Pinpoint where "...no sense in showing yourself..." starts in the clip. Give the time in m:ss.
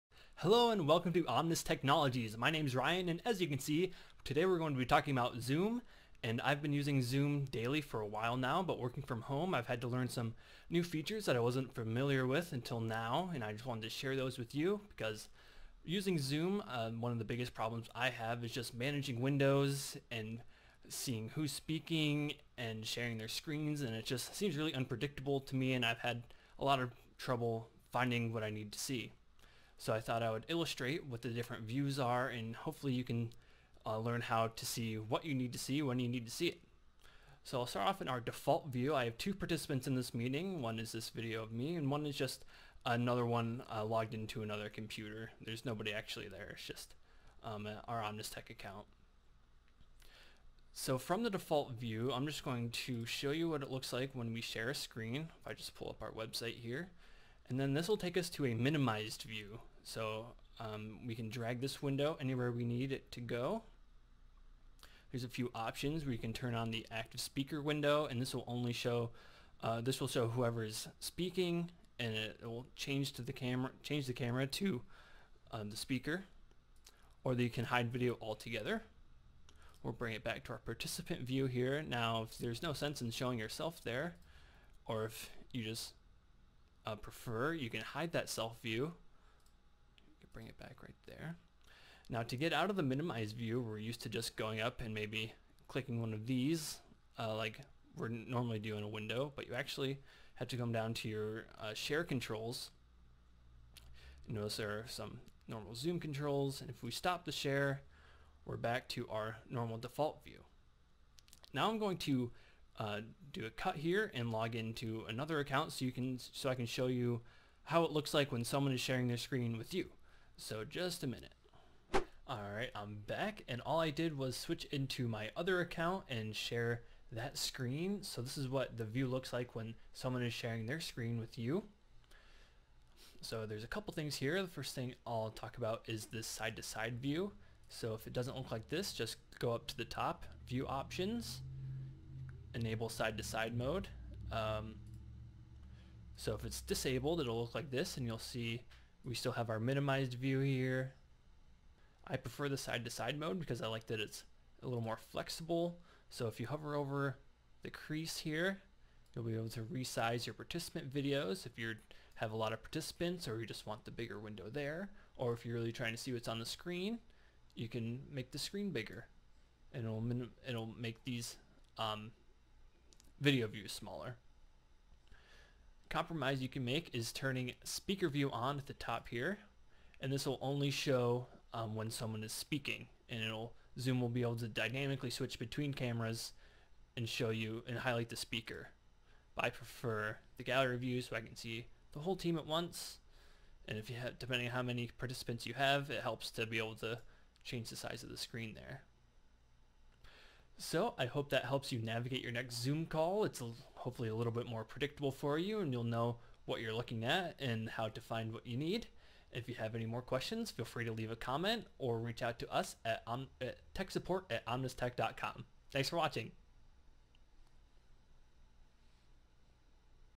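1:22.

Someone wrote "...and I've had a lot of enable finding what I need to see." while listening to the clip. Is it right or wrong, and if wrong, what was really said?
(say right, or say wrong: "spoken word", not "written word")
wrong: "trouble", not "enable".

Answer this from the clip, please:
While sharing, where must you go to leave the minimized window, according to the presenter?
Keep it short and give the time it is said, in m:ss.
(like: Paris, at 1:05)
share controls, at 1:41.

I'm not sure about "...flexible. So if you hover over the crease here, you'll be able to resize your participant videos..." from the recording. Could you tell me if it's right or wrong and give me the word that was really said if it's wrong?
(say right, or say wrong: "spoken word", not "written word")
right.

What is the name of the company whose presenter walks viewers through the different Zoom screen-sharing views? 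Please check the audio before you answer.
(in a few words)
Omnis Technologies.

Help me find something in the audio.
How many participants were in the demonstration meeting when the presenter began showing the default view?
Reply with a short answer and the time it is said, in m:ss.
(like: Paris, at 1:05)
2, at 0:39.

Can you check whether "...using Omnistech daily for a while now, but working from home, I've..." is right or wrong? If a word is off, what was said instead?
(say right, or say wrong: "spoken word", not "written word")
wrong: "Zoom", not "Omnistech".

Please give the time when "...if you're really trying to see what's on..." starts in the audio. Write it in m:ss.
2:45.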